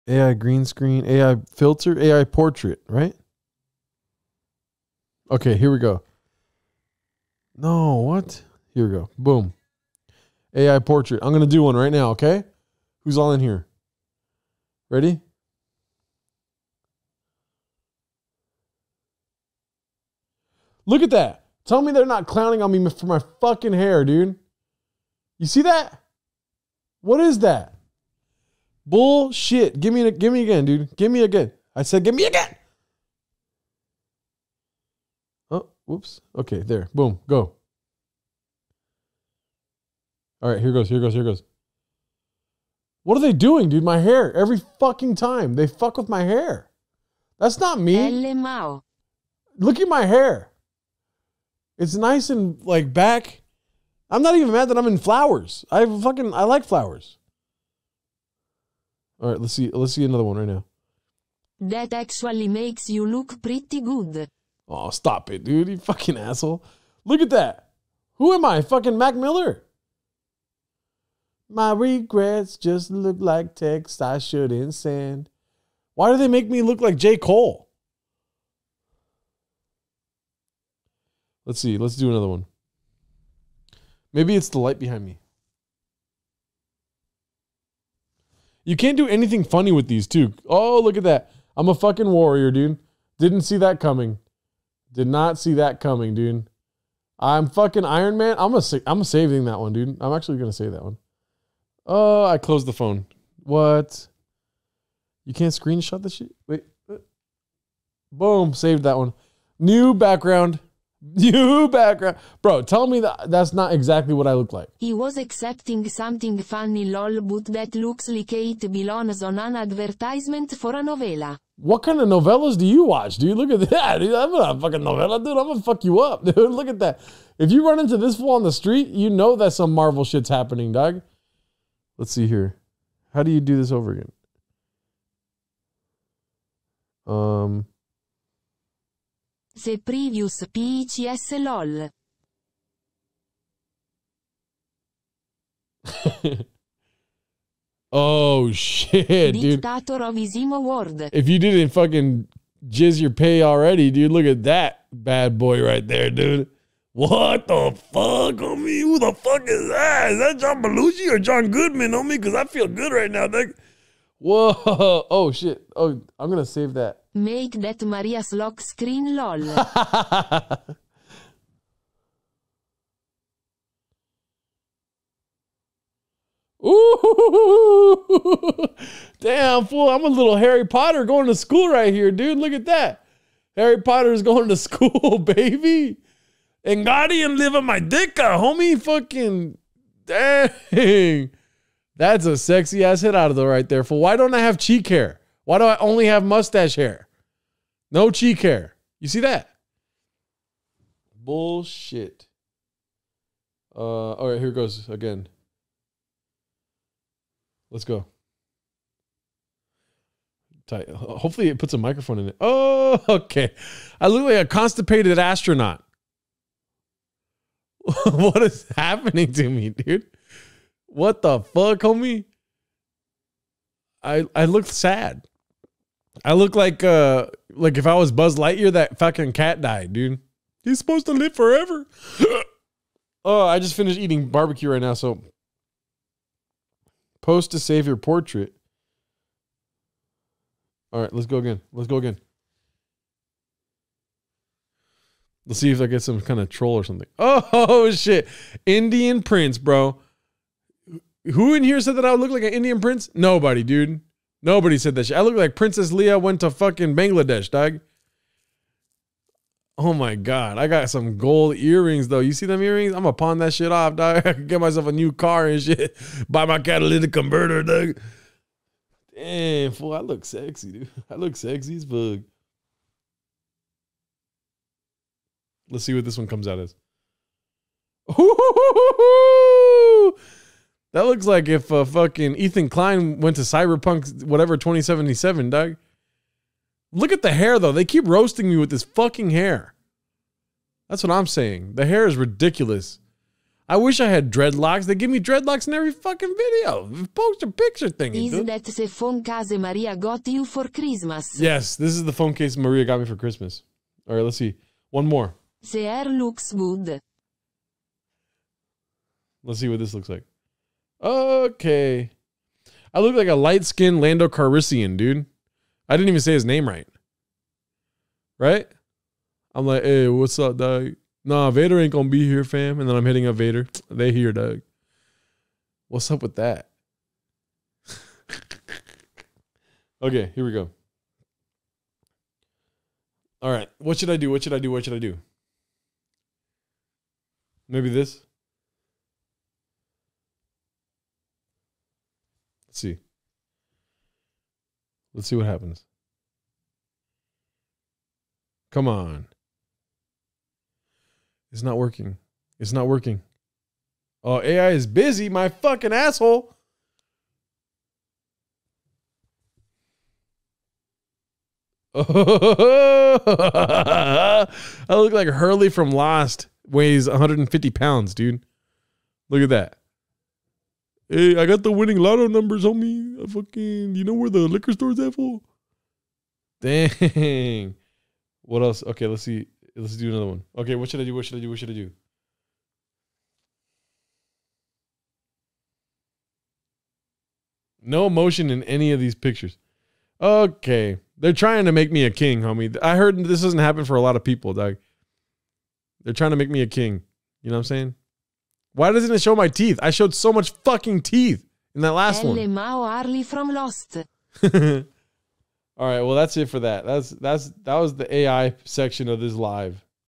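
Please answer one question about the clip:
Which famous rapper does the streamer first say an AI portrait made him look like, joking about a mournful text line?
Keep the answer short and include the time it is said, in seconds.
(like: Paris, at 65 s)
Mac Miller, at 68 s.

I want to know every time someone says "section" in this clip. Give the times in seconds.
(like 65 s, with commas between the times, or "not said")
408 s.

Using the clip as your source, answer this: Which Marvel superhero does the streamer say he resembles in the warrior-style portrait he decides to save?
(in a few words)
Iron Man.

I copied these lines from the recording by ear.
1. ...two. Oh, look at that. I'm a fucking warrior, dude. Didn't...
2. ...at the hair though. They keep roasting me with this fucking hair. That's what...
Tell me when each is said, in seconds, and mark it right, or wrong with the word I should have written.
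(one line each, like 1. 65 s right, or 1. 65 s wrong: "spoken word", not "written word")
1. 90 s right
2. 287 s right.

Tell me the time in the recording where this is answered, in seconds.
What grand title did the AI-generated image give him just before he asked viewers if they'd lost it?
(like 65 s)
149 s.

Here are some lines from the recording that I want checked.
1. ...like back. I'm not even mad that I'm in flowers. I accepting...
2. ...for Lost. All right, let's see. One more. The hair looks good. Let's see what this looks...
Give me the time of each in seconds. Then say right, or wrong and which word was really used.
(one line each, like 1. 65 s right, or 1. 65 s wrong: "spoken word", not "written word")
1. 52 s wrong: "fucking", not "accepting"
2. 303 s wrong: "Christmas", not "Lost".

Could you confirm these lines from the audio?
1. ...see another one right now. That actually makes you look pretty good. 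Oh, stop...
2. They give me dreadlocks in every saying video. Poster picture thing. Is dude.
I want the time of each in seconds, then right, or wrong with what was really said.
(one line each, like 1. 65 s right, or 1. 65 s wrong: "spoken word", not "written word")
1. 59 s right
2. 294 s wrong: "fucking", not "saying".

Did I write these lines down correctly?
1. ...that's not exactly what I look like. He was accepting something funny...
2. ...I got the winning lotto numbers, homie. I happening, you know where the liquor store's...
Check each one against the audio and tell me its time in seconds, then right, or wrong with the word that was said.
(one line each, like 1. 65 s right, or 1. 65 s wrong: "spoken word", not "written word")
1. 113 s right
2. 371 s wrong: "fucking", not "happening".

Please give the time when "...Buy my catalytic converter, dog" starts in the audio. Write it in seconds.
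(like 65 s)
266 s.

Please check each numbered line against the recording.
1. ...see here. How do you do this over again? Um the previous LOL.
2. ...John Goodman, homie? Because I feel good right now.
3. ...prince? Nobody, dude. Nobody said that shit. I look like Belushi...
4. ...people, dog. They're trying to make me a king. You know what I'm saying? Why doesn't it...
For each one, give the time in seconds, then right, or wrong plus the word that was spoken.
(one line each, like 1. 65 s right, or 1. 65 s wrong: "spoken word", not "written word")
1. 132 s right
2. 161 s right
3. 252 s wrong: "Princess", not "Belushi"
4. 394 s right.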